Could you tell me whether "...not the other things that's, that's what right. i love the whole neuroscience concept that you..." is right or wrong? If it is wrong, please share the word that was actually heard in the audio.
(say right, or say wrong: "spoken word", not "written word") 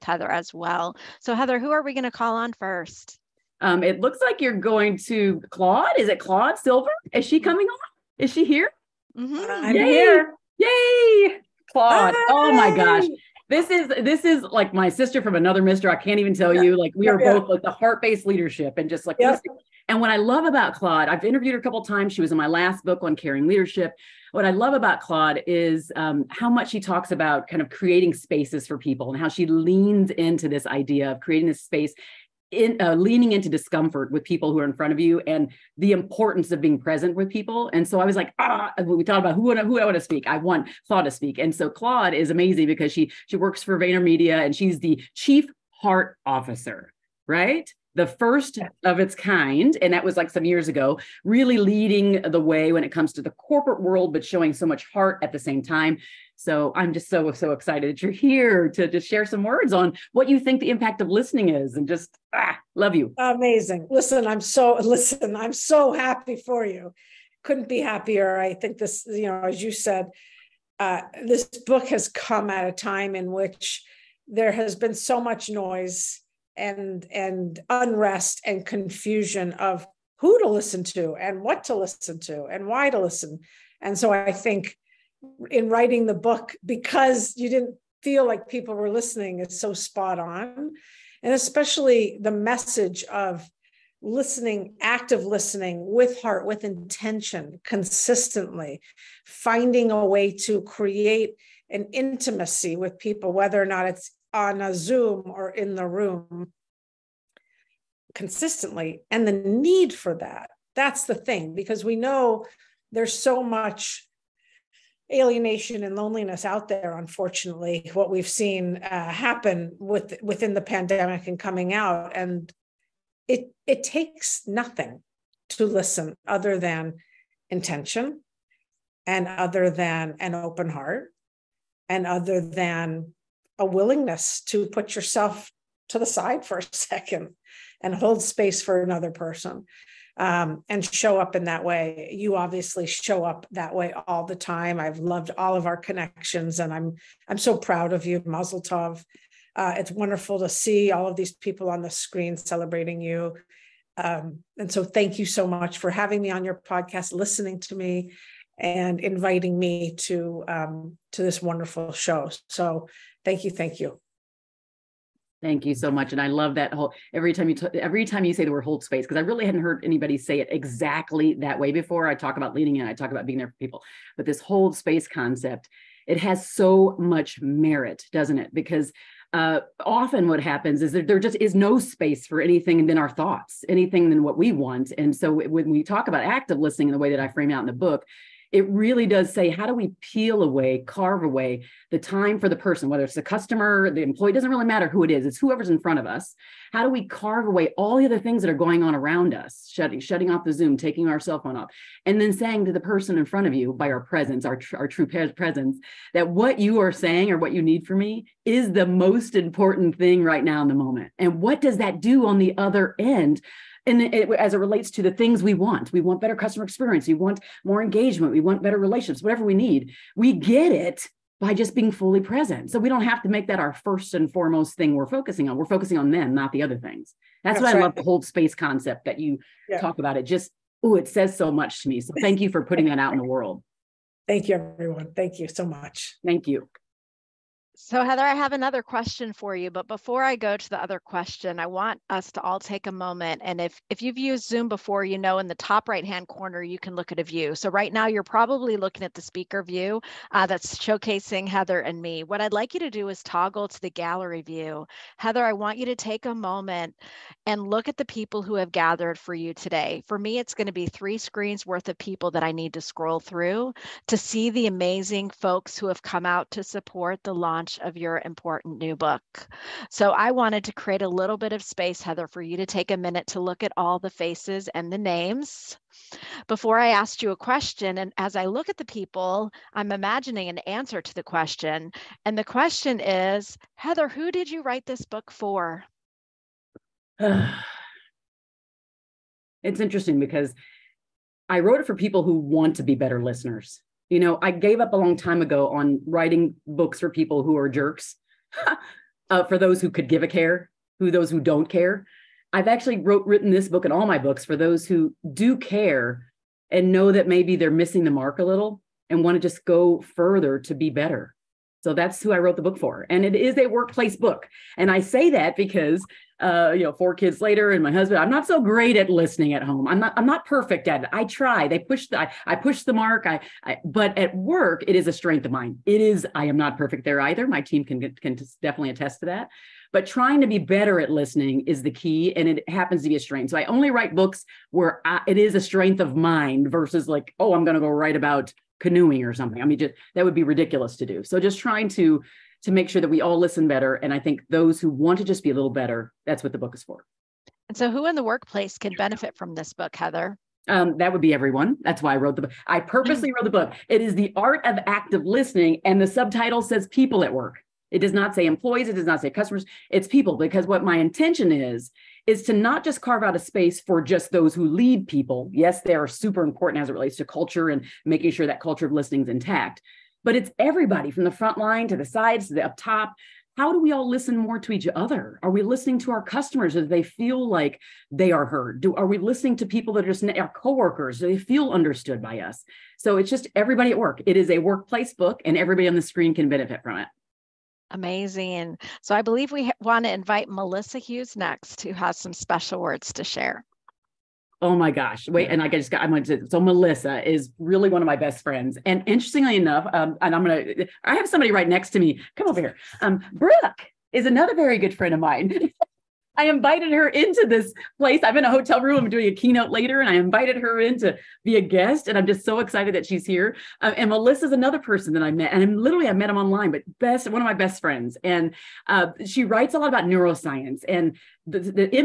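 wrong: "space", not "neuroscience".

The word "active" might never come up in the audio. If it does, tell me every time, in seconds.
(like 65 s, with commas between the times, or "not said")
94 s, 186 s, 354 s.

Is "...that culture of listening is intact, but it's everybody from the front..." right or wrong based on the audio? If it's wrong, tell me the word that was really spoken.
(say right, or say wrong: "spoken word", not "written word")
right.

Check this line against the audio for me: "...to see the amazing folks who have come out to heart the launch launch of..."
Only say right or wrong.
wrong.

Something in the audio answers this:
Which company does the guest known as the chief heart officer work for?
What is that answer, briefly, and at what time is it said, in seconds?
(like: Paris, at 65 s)
VaynerMedia, at 43 s.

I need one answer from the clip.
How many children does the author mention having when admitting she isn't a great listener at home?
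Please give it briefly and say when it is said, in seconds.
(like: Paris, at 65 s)
4, at 316 s.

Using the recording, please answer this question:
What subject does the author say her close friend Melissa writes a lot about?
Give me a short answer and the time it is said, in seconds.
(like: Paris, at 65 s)
Neuroscience, at 420 s.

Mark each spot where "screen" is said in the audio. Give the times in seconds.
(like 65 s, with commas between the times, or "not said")
151 s, 261 s, 386 s.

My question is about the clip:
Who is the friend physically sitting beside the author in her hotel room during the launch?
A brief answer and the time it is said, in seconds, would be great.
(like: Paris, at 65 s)
Brooke, at 403 s.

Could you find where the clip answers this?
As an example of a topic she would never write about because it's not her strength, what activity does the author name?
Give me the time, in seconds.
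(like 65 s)
338 s.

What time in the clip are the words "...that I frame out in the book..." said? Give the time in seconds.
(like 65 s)
187 s.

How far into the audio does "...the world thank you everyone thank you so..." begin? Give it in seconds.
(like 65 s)
233 s.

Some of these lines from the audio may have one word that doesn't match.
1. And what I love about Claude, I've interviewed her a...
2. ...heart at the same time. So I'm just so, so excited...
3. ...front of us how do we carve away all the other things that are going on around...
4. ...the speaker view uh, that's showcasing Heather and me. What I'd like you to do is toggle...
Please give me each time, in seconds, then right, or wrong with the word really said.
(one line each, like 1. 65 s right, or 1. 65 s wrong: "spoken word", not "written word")
1. 19 s right
2. 54 s right
3. 195 s right
4. 249 s right.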